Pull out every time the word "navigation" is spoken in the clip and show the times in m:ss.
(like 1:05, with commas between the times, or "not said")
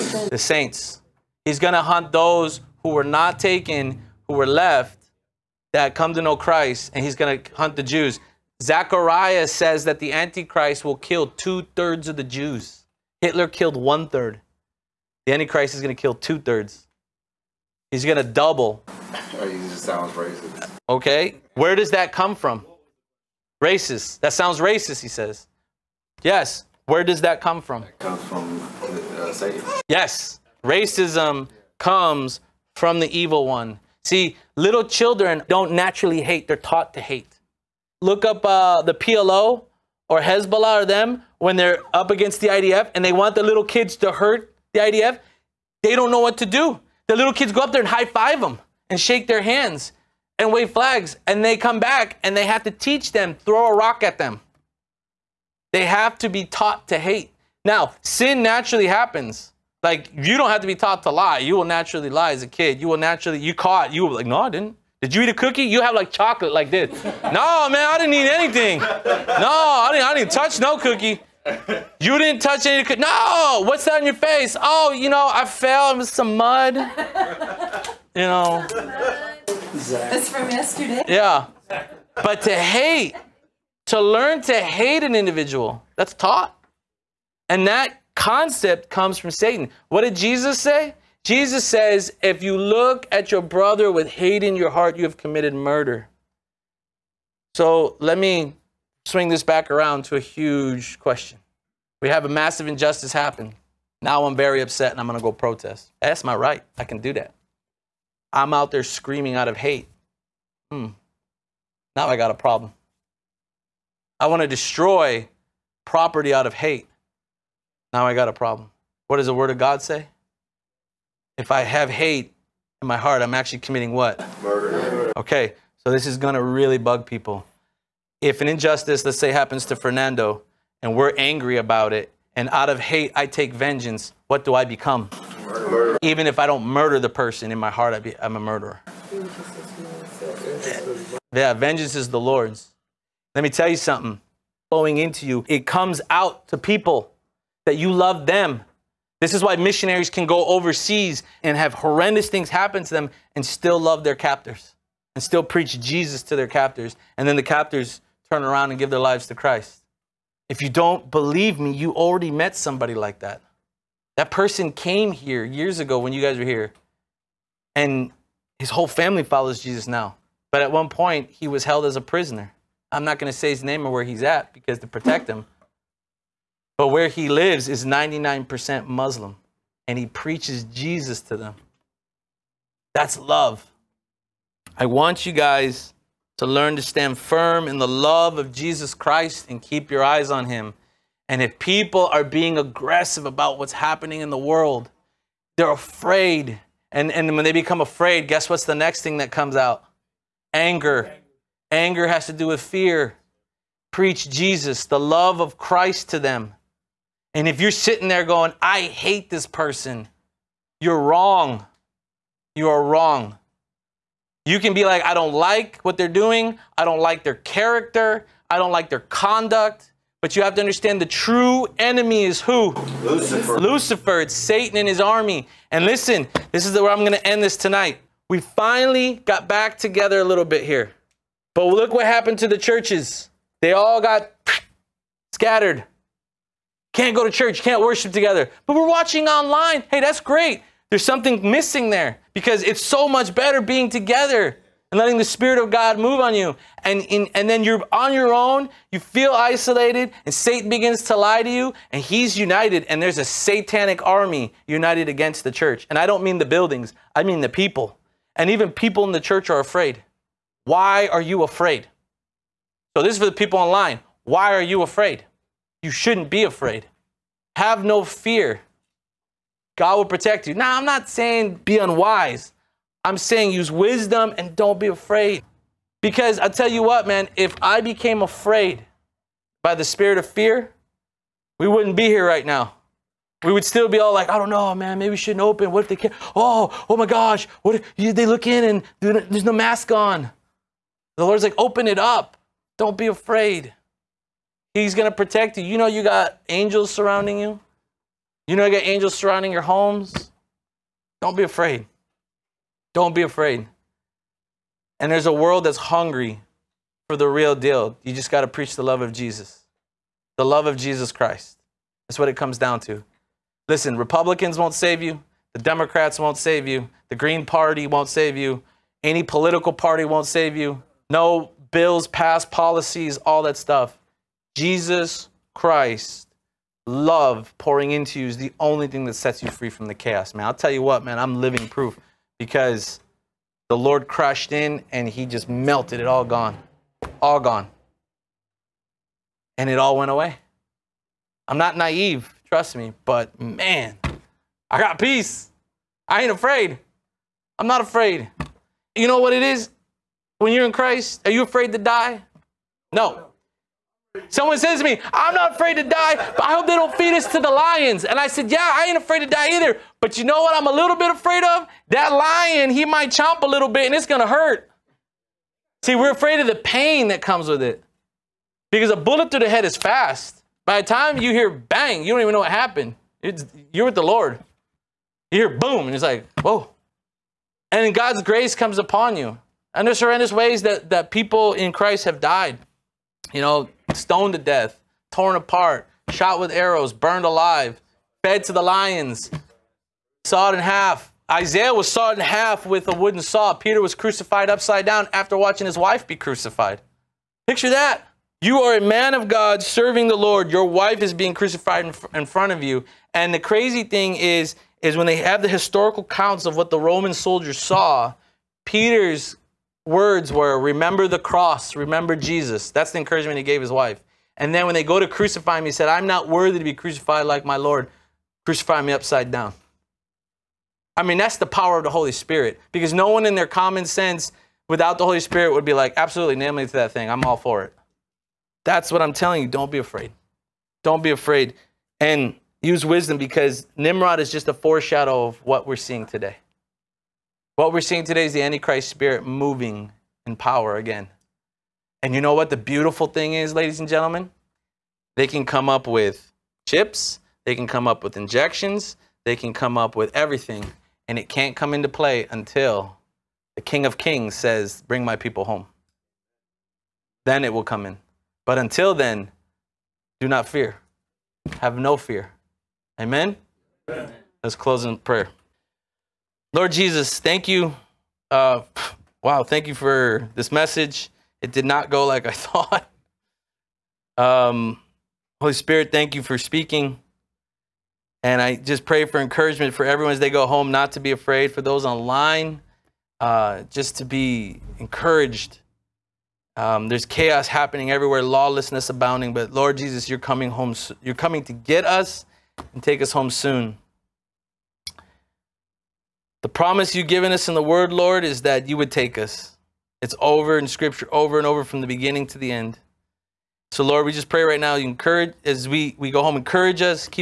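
not said.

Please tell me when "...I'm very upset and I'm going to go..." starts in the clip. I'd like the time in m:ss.
1:44.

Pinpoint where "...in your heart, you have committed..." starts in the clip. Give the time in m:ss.
1:34.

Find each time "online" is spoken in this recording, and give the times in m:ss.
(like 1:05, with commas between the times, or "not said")
3:59, 4:23, 8:01.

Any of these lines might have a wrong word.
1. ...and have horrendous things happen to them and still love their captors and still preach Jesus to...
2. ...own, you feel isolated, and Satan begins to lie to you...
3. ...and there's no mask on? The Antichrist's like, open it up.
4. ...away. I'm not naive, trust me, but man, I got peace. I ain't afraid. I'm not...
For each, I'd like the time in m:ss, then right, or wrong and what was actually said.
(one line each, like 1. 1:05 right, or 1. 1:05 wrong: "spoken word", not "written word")
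1. 2:31 right
2. 4:08 right
3. 4:49 wrong: "Lord", not "Antichrist"
4. 5:40 right.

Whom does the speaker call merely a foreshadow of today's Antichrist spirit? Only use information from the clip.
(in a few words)
Nimrod.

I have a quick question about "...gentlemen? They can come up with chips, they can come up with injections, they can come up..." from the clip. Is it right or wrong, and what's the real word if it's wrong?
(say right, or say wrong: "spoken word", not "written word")
right.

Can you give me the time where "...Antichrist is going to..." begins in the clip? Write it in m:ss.
0:15.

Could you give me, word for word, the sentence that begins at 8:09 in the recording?
But Lord Jesus, you're coming home.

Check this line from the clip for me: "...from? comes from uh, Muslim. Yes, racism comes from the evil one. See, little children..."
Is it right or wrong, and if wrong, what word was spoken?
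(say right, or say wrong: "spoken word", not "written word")
wrong: "Satan", not "Muslim".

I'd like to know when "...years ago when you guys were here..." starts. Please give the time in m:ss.
2:45.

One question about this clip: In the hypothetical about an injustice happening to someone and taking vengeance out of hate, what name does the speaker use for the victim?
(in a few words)
Fernando.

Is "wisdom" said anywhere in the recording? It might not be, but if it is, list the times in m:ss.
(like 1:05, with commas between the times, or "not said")
4:33, 7:12.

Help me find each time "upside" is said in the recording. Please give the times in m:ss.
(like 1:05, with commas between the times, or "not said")
6:34, 6:58.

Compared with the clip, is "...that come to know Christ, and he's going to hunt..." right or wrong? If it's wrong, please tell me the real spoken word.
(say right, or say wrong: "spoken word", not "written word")
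right.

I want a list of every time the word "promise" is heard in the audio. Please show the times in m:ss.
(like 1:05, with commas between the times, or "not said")
8:16.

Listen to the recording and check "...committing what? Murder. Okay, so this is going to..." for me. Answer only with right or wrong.
right.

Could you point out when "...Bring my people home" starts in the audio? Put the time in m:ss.
7:34.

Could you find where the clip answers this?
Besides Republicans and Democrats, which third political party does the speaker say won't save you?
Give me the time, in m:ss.
5:17.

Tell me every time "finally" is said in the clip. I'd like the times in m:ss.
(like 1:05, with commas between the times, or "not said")
3:48.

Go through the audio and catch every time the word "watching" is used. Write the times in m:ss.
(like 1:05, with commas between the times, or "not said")
3:58, 6:35.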